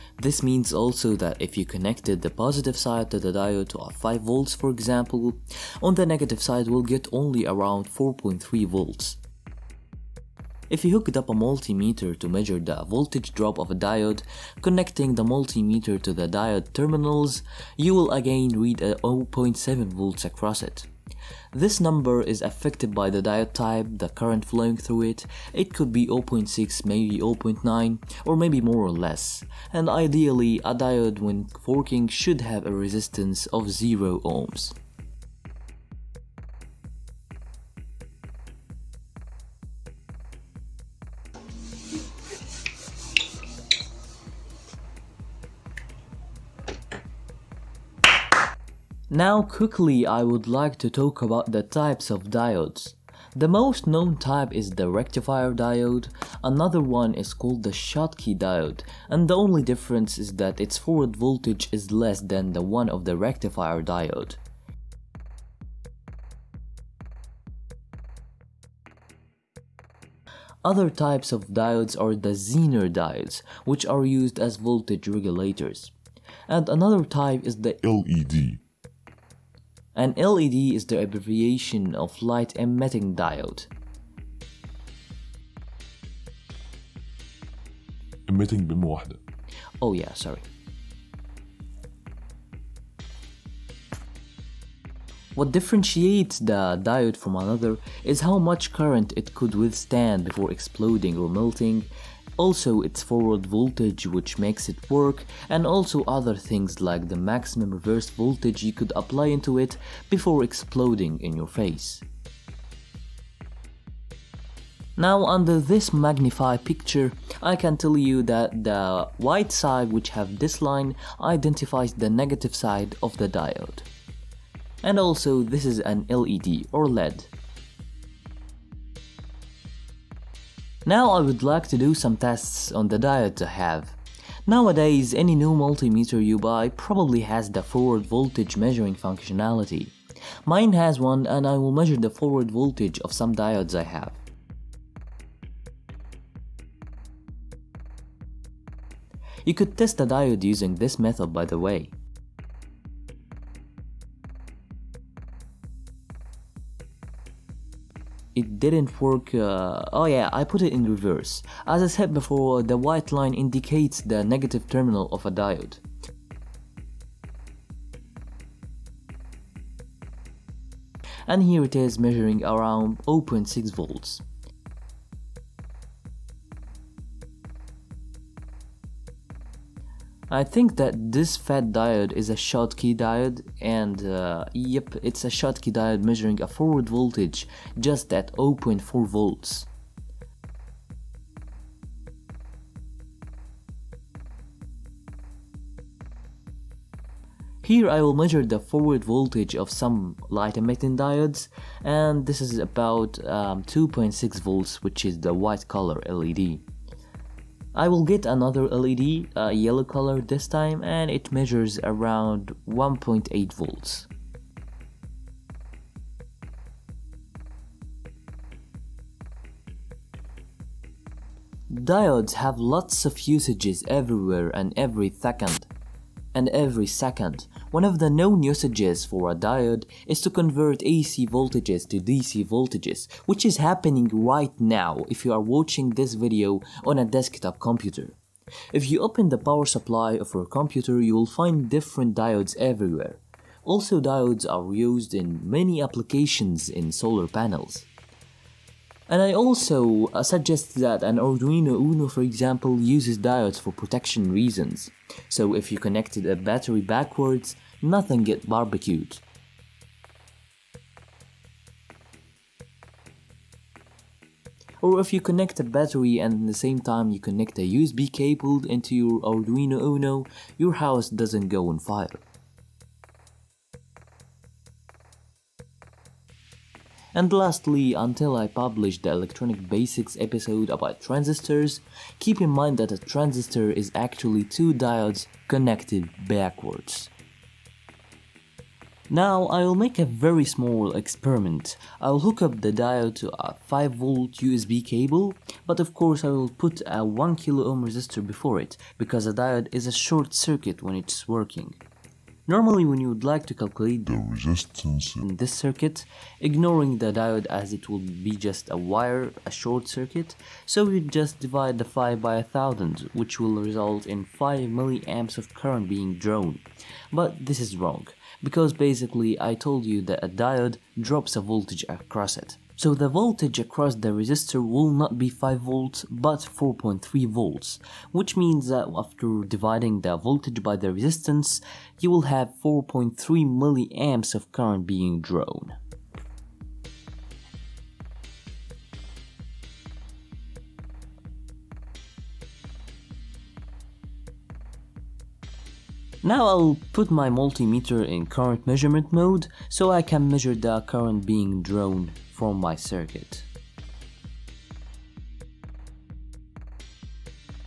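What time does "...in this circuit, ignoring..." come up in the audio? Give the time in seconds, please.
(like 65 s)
305 s.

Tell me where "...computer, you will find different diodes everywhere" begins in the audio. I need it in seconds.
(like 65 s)
240 s.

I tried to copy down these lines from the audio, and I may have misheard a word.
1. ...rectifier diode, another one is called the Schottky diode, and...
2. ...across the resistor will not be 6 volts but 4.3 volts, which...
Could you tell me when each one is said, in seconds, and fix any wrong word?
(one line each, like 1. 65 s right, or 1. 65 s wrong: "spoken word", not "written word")
1. 54 s right
2. 323 s wrong: "5", not "6".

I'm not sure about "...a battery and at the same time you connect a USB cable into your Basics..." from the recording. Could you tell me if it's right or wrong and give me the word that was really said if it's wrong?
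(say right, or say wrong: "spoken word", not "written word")
wrong: "Arduino", not "Basics".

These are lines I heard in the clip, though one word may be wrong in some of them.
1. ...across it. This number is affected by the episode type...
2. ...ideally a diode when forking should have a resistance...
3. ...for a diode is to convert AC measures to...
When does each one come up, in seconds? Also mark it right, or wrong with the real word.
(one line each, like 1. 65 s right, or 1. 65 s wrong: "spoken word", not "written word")
1. 20 s wrong: "diode", not "episode"
2. 29 s right
3. 229 s wrong: "voltages", not "measures".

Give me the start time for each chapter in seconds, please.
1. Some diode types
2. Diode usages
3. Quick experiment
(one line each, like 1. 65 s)
1. 47 s
2. 227 s
3. 294 s.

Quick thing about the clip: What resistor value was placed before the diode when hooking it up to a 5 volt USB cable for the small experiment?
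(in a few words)
1 kilo ohm.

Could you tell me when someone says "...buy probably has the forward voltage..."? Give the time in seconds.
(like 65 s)
136 s.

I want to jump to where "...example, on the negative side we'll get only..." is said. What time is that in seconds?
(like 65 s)
4 s.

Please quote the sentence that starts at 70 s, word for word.
Other types of diodes are the Zener diodes, which are used as voltage regulators.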